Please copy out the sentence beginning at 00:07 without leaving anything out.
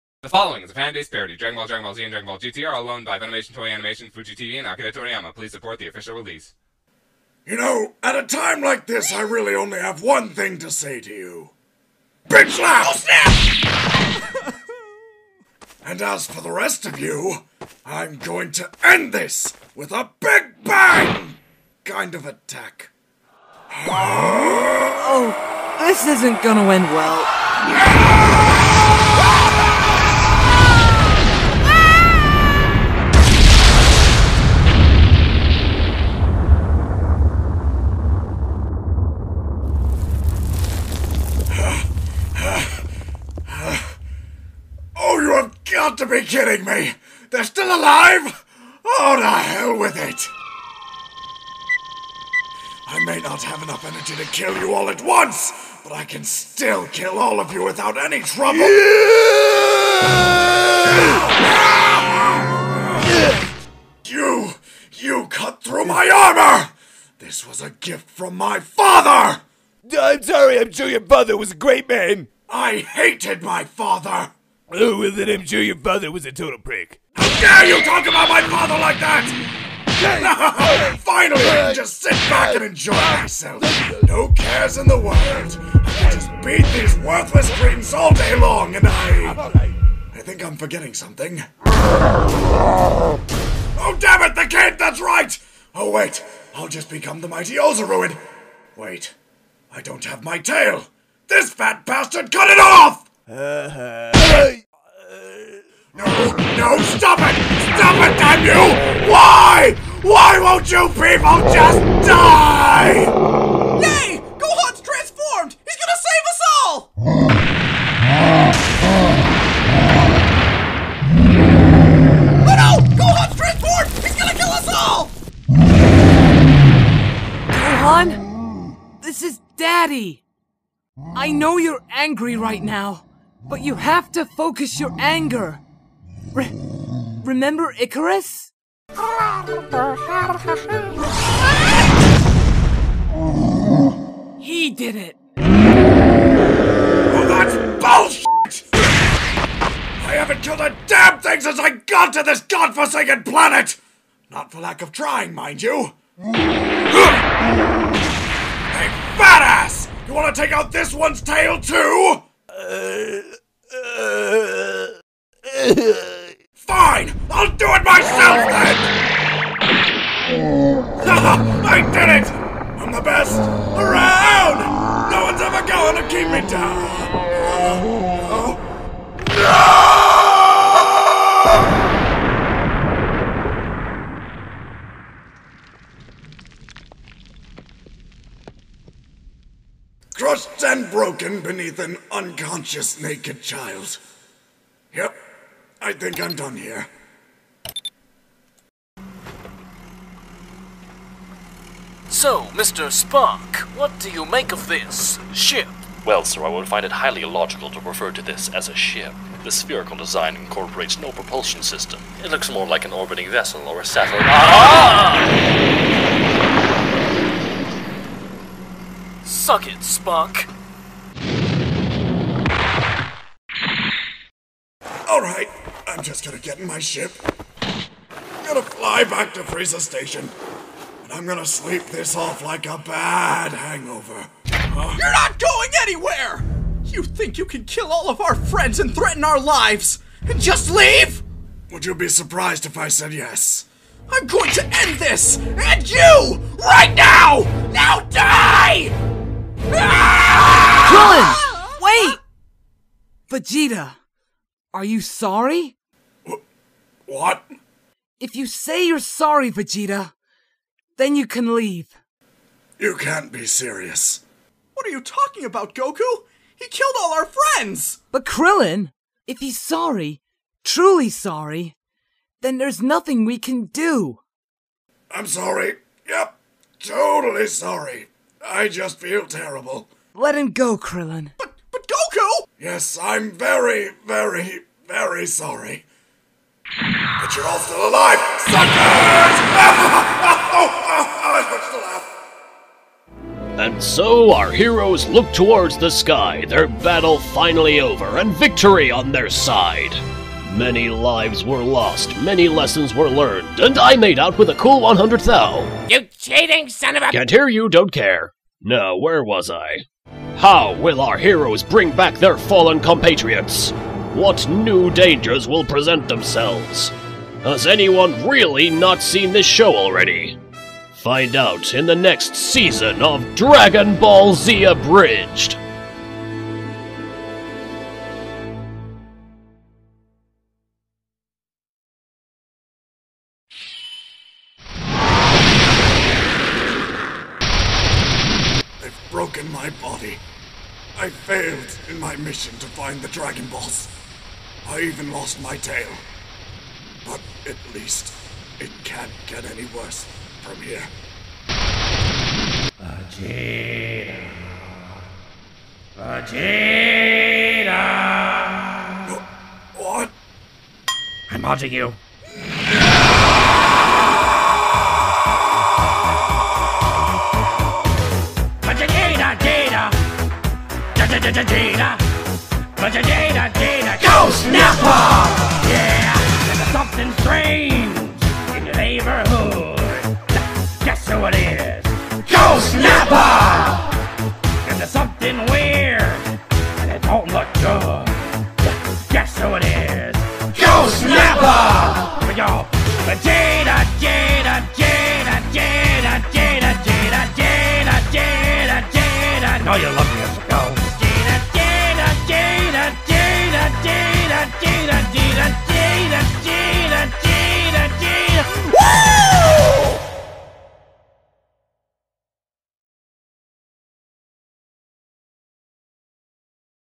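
You know, at a time like this, I really only have one thing to say to you.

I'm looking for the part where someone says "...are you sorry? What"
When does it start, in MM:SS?
04:14.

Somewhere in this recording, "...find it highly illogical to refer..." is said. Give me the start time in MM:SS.
03:26.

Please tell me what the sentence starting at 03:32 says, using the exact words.
It looks more like an orbiting vessel or a satellite.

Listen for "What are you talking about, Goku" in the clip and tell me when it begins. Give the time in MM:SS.
04:24.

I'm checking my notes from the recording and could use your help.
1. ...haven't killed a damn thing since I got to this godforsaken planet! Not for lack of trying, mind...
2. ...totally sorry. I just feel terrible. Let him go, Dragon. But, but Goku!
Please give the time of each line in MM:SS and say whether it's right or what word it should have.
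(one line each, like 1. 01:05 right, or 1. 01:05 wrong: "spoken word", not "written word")
1. 02:30 right
2. 04:36 wrong: "Krillin", not "Dragon".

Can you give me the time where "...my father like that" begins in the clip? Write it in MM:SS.
01:18.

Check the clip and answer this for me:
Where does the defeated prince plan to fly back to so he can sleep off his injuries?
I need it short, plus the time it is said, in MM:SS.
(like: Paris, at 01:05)
Frieza Station, at 03:49.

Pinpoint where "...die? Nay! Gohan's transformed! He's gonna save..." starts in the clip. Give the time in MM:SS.
01:52.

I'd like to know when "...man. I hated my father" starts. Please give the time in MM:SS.
01:11.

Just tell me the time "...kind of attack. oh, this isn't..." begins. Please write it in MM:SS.
00:21.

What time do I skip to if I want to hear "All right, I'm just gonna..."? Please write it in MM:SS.
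03:45.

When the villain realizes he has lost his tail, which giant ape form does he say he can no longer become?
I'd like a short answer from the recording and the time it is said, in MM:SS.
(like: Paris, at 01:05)
Ozaruid, at 01:37.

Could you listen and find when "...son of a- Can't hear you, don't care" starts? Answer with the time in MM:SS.
05:06.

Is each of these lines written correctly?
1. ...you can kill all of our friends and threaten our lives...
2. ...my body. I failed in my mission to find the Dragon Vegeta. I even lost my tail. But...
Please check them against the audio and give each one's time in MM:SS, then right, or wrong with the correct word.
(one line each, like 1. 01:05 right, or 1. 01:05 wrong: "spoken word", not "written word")
1. 03:57 right
2. 05:39 wrong: "Balls", not "Vegeta".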